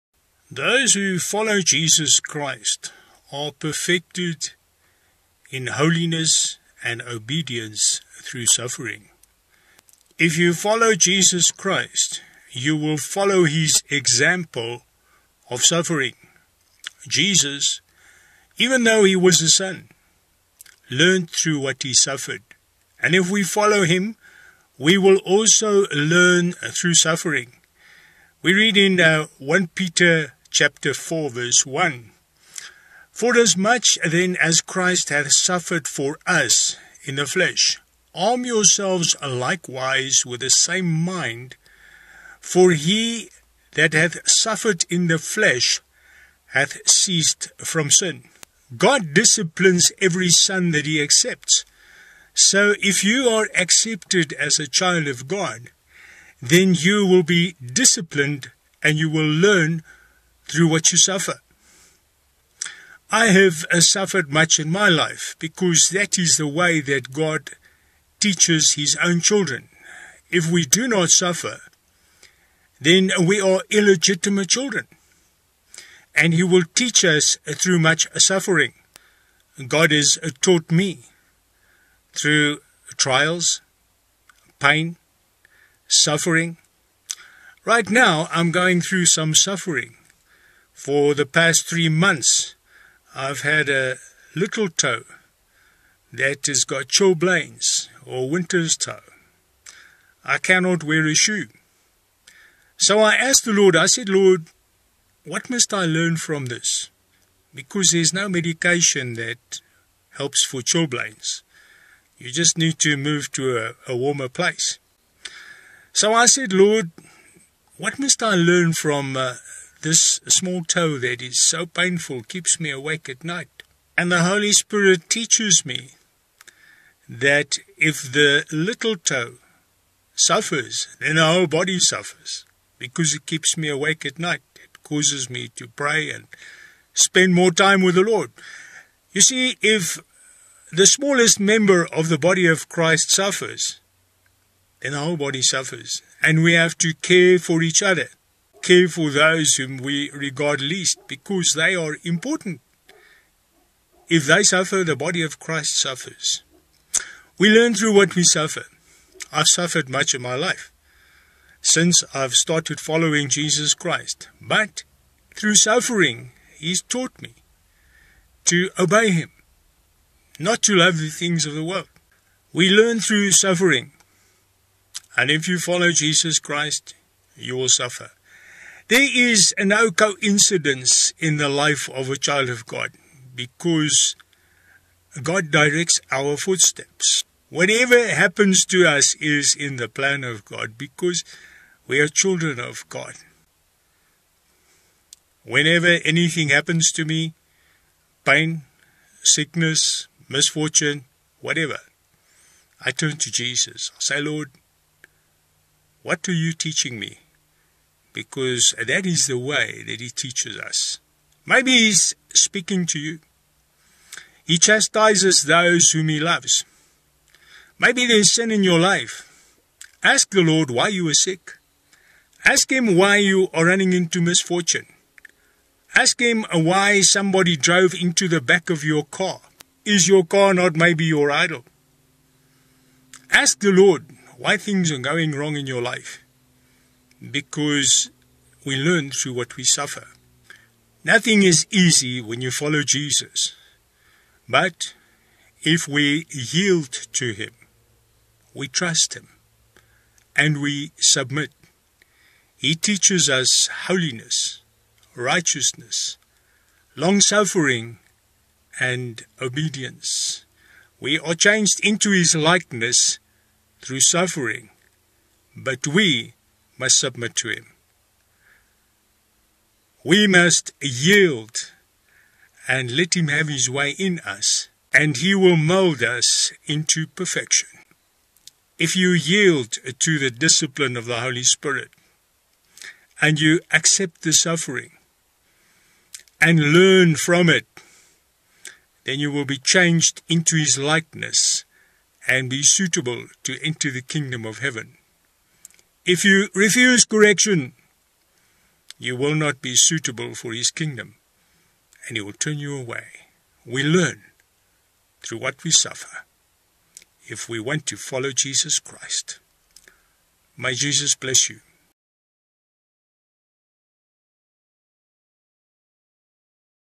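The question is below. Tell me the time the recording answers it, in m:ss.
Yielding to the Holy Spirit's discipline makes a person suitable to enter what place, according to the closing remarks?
4:54.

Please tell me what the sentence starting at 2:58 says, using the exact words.
There is no coincidence in the life of a child of God because God directs our footsteps.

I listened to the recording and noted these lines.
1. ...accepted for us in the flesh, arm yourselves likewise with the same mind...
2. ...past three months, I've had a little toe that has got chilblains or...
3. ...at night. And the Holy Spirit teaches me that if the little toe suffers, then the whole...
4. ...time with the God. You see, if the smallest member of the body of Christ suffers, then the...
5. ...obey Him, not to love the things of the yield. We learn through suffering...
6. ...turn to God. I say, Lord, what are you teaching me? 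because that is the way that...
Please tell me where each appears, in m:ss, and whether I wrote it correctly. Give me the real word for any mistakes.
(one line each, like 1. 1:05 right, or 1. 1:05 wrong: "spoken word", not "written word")
1. 0:35 wrong: "suffered", not "accepted"
2. 1:31 right
3. 2:03 right
4. 2:17 wrong: "Lord", not "God"
5. 2:48 wrong: "world", not "yield"
6. 3:22 wrong: "Jesus", not "God".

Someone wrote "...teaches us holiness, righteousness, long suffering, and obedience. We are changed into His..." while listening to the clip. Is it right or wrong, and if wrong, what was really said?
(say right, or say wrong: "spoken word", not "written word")
right.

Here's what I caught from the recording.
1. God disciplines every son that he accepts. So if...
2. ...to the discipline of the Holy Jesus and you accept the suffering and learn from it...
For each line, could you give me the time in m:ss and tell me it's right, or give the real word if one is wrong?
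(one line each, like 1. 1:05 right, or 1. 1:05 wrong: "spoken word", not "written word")
1. 0:48 right
2. 4:40 wrong: "Spirit", not "Jesus".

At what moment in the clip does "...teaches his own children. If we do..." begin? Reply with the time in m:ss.
1:08.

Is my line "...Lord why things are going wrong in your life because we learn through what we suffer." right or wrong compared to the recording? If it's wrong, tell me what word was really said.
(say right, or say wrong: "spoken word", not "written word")
right.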